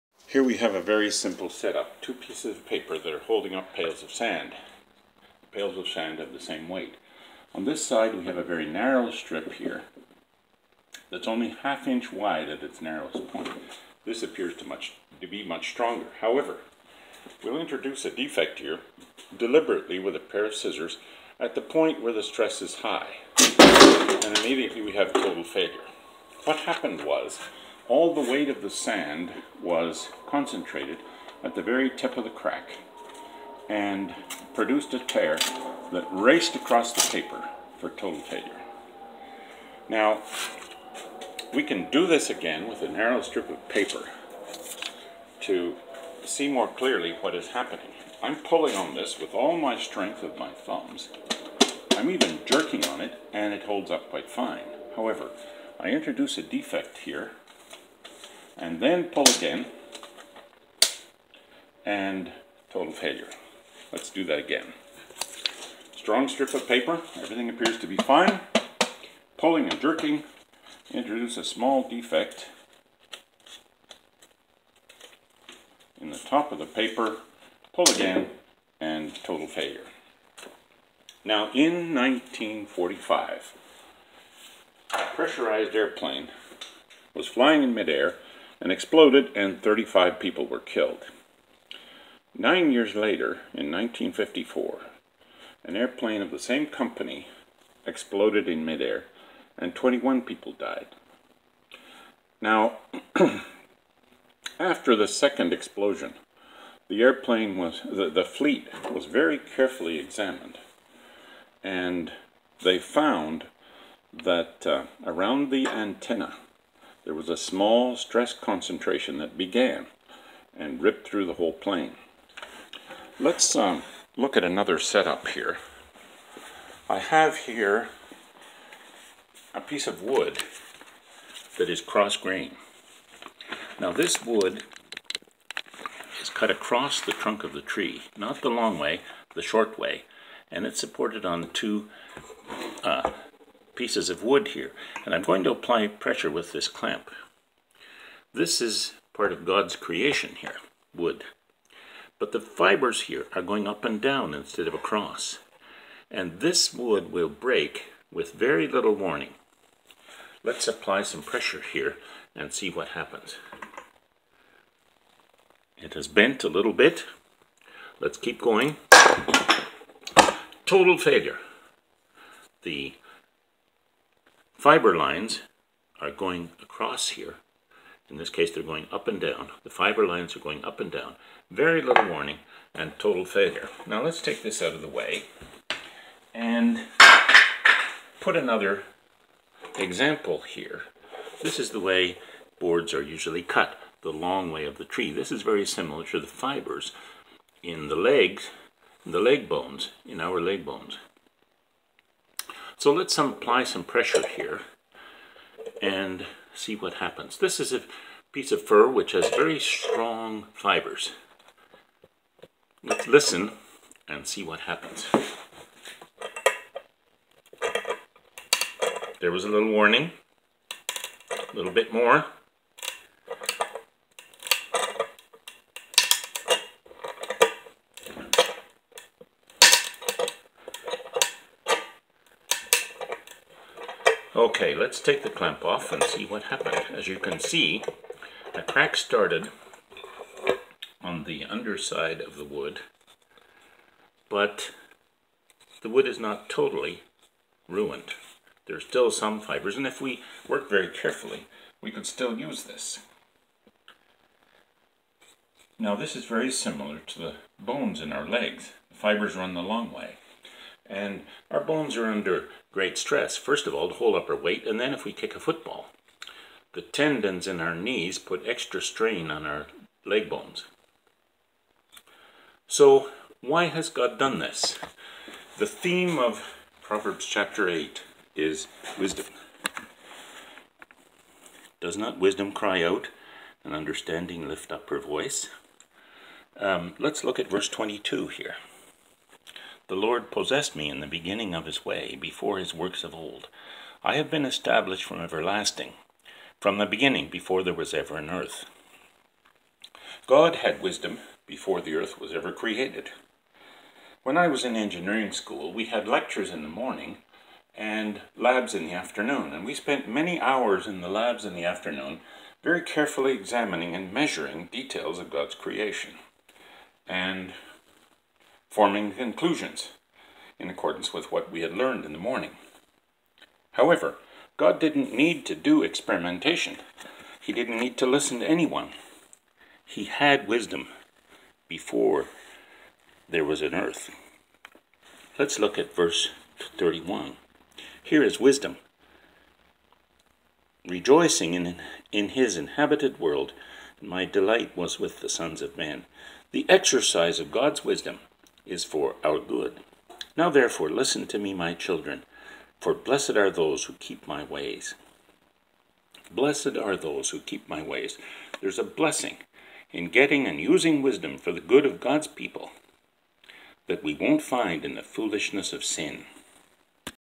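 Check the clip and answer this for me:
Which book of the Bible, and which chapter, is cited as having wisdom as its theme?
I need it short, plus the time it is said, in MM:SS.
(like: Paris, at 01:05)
Proverbs 8, at 04:36.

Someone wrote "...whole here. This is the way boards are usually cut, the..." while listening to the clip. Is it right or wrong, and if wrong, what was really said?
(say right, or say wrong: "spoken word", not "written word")
wrong: "example", not "whole".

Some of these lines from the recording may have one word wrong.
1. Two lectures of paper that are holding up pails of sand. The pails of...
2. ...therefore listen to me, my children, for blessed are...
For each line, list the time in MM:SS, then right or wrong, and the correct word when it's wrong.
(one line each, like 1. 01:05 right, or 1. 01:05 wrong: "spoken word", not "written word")
1. 00:01 wrong: "pieces", not "lectures"
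2. 05:50 right.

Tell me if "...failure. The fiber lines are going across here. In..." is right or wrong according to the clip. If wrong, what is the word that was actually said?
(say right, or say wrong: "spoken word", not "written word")
right.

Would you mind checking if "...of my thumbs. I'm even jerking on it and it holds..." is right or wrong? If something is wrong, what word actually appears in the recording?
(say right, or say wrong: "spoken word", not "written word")
right.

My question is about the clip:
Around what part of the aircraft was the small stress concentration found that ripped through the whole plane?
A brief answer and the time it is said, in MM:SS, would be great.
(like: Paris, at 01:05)
the antenna, at 01:55.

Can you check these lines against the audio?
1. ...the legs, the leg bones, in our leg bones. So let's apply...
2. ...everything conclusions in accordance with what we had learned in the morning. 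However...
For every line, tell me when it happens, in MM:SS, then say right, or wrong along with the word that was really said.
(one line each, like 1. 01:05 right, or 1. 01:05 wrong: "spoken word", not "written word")
1. 03:17 right
2. 05:18 wrong: "forming", not "everything".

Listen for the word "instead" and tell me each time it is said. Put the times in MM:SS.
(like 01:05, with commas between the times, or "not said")
02:34.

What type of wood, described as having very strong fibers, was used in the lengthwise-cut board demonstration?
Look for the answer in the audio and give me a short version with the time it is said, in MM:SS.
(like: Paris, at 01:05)
fir, at 03:28.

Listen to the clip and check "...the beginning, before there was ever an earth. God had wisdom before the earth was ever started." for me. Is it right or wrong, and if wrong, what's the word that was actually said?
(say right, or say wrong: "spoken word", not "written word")
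wrong: "created", not "started".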